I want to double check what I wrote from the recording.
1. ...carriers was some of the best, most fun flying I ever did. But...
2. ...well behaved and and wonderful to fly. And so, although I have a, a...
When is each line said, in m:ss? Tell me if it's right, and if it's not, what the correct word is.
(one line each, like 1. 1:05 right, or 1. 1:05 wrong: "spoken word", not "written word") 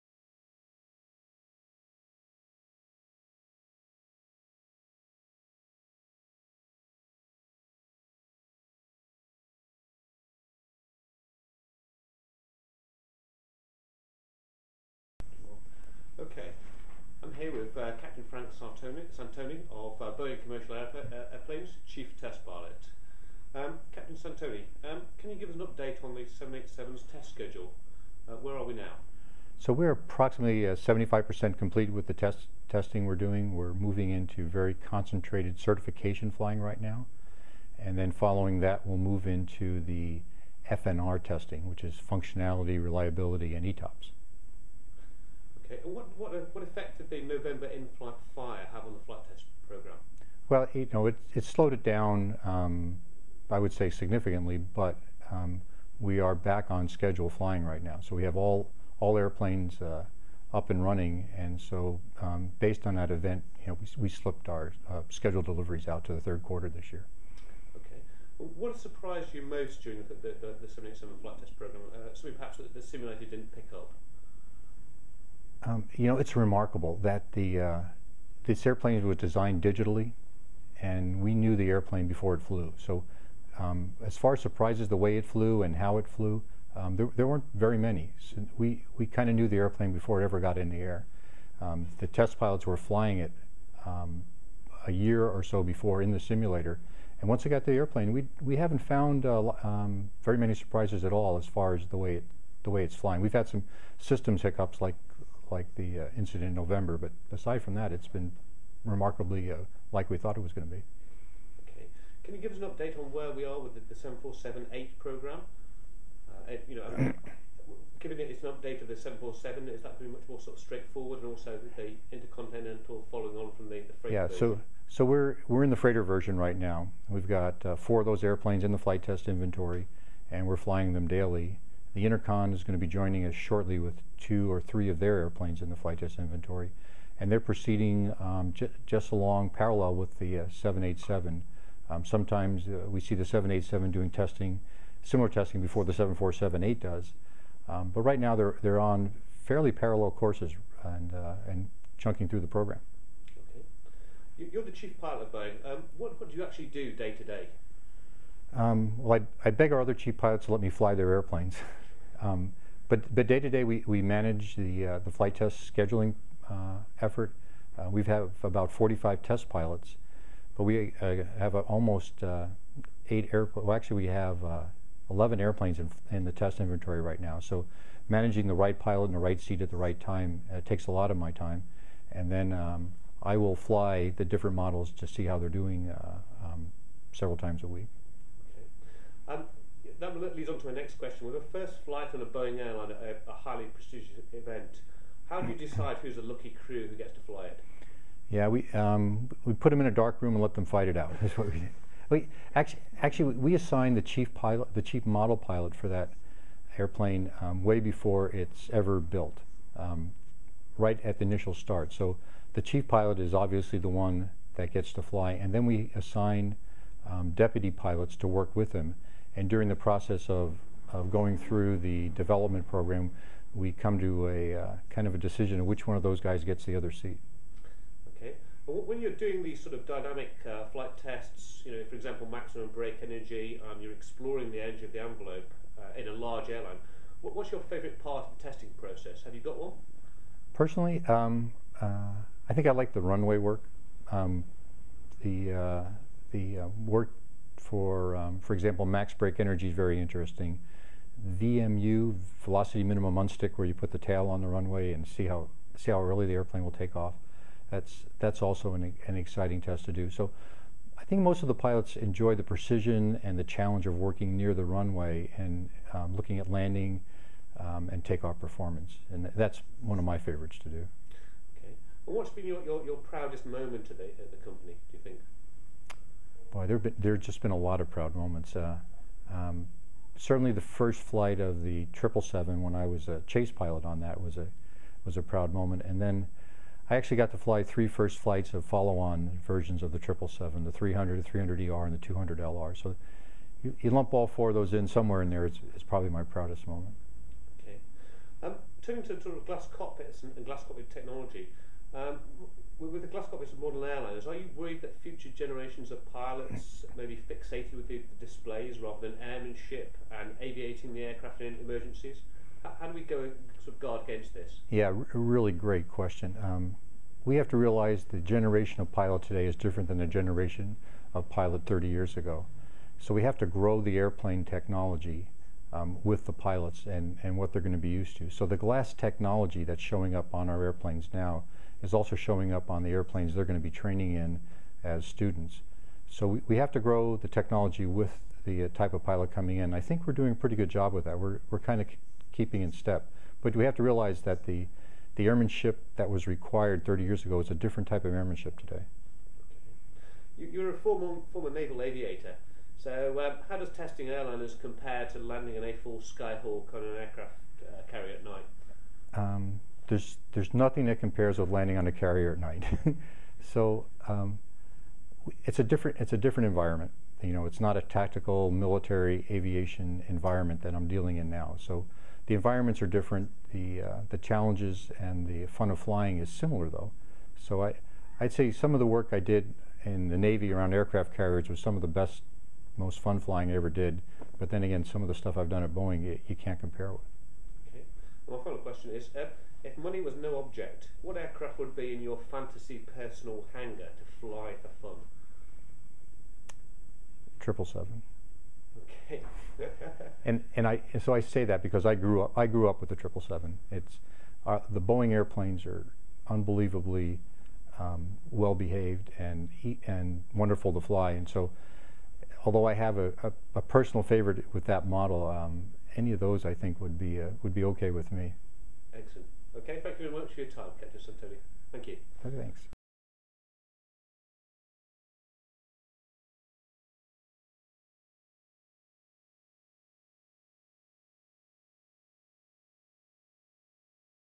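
1. 6:21 right
2. 6:48 right.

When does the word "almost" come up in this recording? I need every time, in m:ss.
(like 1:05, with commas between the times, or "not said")
2:51.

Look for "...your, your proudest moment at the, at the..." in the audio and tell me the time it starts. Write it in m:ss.
4:32.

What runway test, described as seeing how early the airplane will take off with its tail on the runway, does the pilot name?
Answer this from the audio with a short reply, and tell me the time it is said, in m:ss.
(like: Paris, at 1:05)
Velocity minimum unstick, at 4:12.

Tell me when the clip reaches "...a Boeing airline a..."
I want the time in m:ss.
3:12.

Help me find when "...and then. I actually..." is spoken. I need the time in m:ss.
4:45.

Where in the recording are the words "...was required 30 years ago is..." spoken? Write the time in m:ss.
5:46.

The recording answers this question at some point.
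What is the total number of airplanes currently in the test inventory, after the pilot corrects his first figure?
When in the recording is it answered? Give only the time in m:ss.
2:55.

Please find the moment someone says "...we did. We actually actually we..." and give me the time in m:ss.
3:21.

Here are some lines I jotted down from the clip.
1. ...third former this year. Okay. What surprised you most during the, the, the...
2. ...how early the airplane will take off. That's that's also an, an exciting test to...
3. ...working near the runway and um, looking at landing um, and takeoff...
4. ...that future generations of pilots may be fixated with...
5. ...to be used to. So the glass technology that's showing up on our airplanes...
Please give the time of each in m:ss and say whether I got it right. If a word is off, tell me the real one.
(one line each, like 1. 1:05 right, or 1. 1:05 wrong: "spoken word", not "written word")
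1. 1:06 wrong: "quarter", not "former"
2. 4:15 right
3. 4:23 right
4. 5:04 right
5. 5:27 right.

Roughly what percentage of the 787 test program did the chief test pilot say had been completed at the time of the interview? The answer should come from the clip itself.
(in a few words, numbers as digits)
75%.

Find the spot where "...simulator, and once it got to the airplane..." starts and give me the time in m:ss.
1:36.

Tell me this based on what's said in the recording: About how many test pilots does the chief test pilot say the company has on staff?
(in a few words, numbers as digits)
45.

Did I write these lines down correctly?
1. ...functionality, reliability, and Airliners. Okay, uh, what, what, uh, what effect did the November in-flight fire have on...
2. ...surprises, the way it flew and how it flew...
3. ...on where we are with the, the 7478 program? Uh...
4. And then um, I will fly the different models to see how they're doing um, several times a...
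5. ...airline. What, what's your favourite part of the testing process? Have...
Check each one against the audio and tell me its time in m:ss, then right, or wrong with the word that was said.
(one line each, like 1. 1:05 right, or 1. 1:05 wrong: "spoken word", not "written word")
1. 0:42 wrong: "ETOPS", not "Airliners"
2. 1:24 right
3. 1:52 right
4. 3:02 right
5. 3:56 right.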